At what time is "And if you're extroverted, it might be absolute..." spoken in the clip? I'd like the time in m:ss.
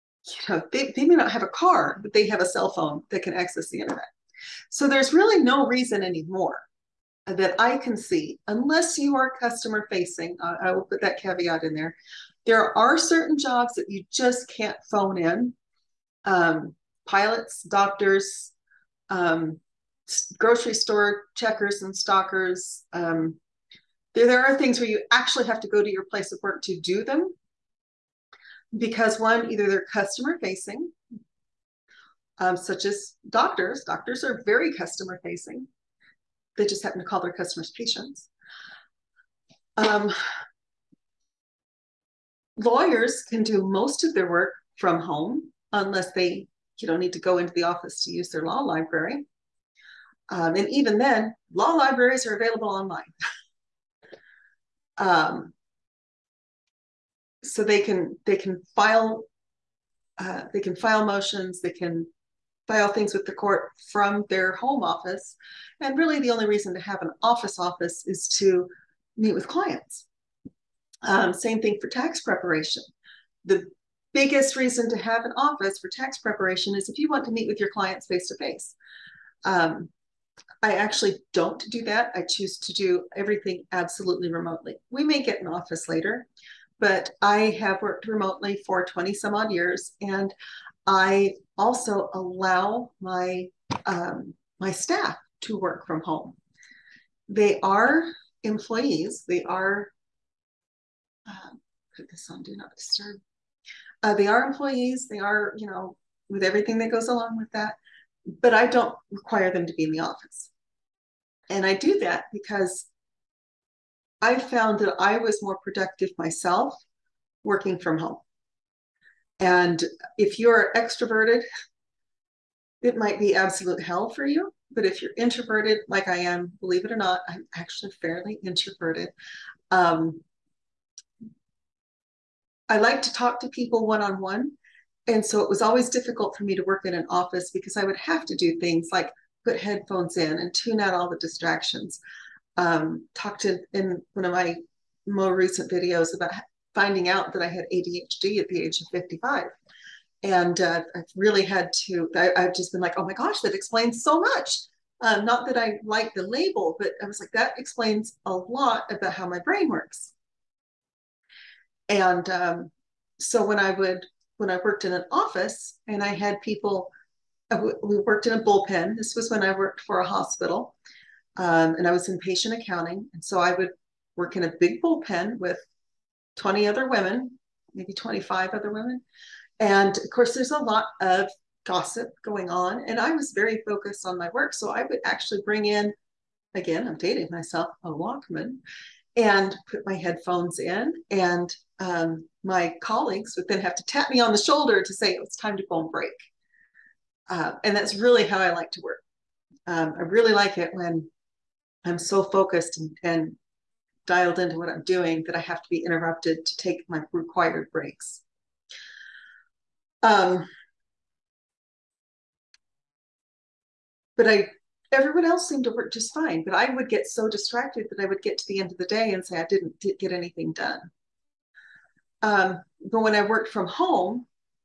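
1:59.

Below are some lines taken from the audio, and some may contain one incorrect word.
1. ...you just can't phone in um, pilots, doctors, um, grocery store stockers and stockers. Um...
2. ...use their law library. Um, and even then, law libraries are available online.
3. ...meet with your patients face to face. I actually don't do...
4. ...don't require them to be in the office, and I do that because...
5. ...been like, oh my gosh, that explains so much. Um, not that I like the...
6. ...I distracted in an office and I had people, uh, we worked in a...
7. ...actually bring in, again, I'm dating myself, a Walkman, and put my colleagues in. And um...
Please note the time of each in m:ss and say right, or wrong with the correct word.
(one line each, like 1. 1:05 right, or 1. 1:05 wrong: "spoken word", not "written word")
1. 0:13 wrong: "checkers", not "stockers"
2. 0:48 right
3. 1:17 wrong: "clients", not "patients"
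4. 1:48 right
5. 2:32 right
6. 2:44 wrong: "worked", not "distracted"
7. 3:05 wrong: "headphones", not "colleagues".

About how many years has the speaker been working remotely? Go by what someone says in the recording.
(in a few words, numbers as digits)
20-some years.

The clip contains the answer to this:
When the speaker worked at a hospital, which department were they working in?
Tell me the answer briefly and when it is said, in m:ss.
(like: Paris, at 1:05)
patient accounting, at 2:52.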